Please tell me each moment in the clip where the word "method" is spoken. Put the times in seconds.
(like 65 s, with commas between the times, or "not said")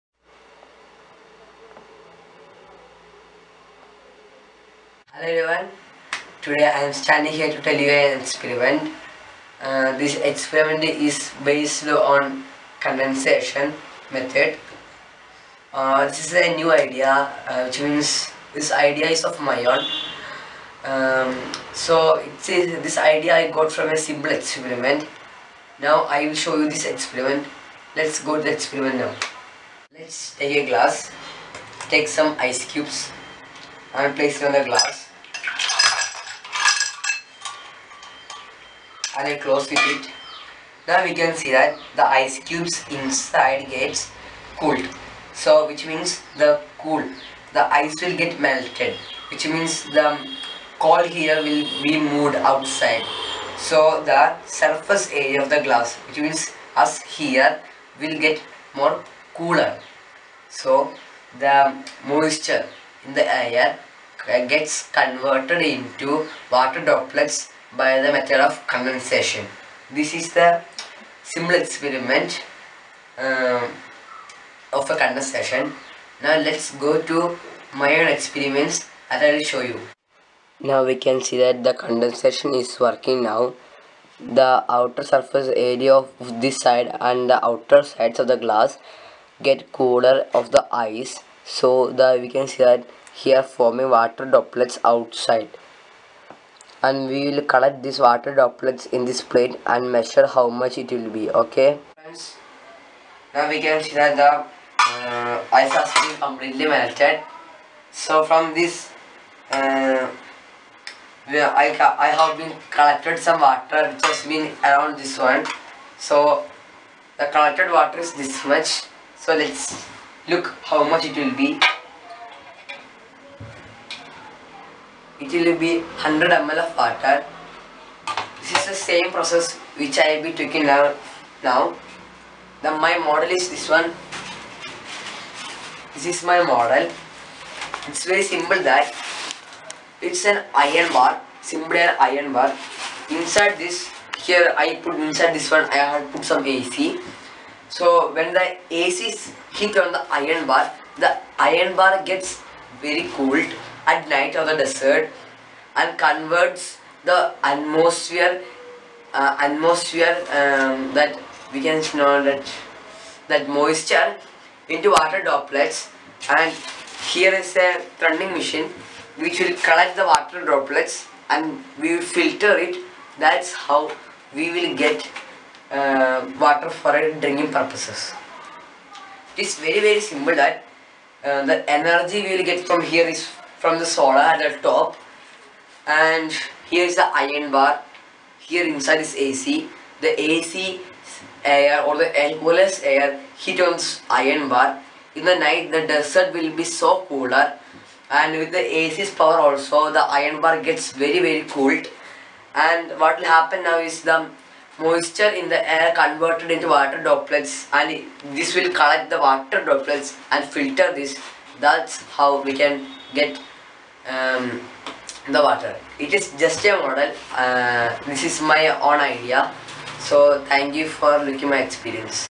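14 s, 68 s.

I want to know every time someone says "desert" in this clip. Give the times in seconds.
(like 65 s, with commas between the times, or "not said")
154 s, 195 s.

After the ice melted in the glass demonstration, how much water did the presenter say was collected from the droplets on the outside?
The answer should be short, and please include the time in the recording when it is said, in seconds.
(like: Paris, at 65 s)
100 ml, at 125 s.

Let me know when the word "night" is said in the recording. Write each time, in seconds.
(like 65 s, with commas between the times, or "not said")
154 s, 195 s.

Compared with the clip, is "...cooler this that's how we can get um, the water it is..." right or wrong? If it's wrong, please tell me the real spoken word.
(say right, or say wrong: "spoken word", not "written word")
wrong: "filter", not "cooler".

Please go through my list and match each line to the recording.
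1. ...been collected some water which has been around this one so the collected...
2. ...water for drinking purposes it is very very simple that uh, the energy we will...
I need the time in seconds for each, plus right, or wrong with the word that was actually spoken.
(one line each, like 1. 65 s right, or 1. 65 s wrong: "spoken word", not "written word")
1. 112 s right
2. 176 s right.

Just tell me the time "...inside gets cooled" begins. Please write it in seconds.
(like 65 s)
42 s.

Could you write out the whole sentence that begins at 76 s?
Now let's go to my own experiments that I will show you.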